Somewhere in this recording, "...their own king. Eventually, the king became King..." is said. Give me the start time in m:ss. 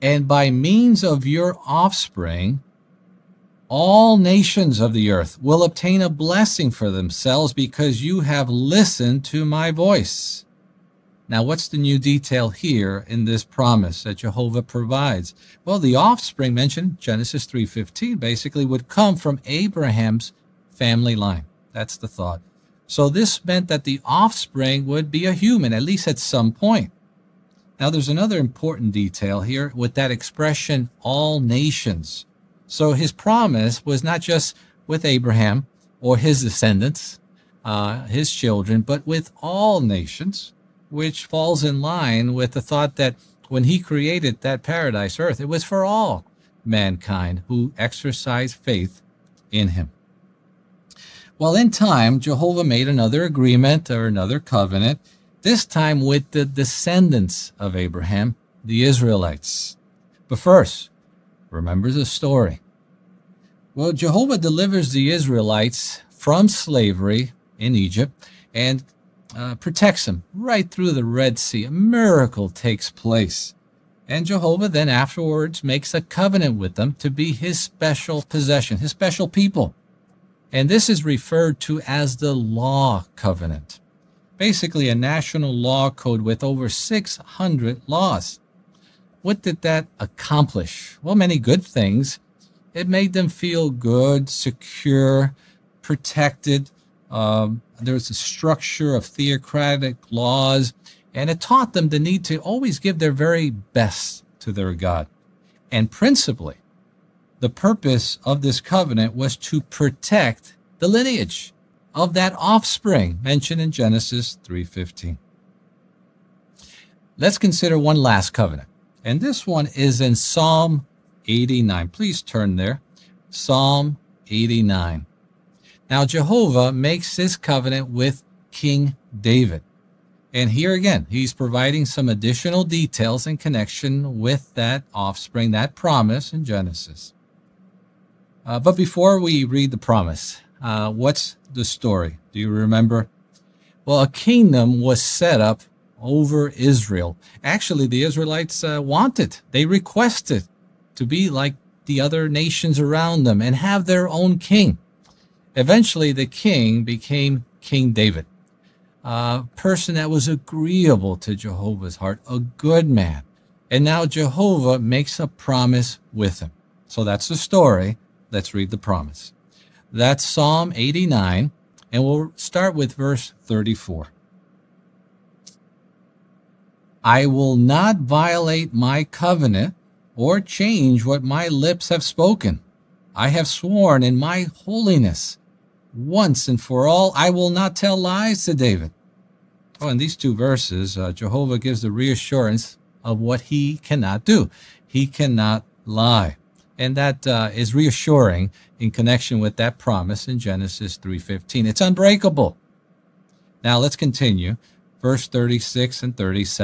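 2:33.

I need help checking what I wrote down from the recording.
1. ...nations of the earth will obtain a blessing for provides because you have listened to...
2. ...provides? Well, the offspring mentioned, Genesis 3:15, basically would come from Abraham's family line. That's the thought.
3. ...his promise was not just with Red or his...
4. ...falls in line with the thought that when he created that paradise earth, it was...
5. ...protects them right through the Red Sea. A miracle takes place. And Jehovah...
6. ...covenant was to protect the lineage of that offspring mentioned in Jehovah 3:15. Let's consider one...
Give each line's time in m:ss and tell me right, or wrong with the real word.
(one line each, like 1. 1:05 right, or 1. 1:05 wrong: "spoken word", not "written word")
1. 0:04 wrong: "themselves", not "provides"
2. 0:14 right
3. 0:32 wrong: "Abraham", not "Red"
4. 0:41 right
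5. 1:09 right
6. 1:48 wrong: "Genesis", not "Jehovah".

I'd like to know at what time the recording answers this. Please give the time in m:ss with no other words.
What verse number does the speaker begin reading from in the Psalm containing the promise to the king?
2:52.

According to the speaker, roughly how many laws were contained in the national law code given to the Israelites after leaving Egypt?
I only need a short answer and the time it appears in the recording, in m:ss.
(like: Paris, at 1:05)
over 600, at 1:26.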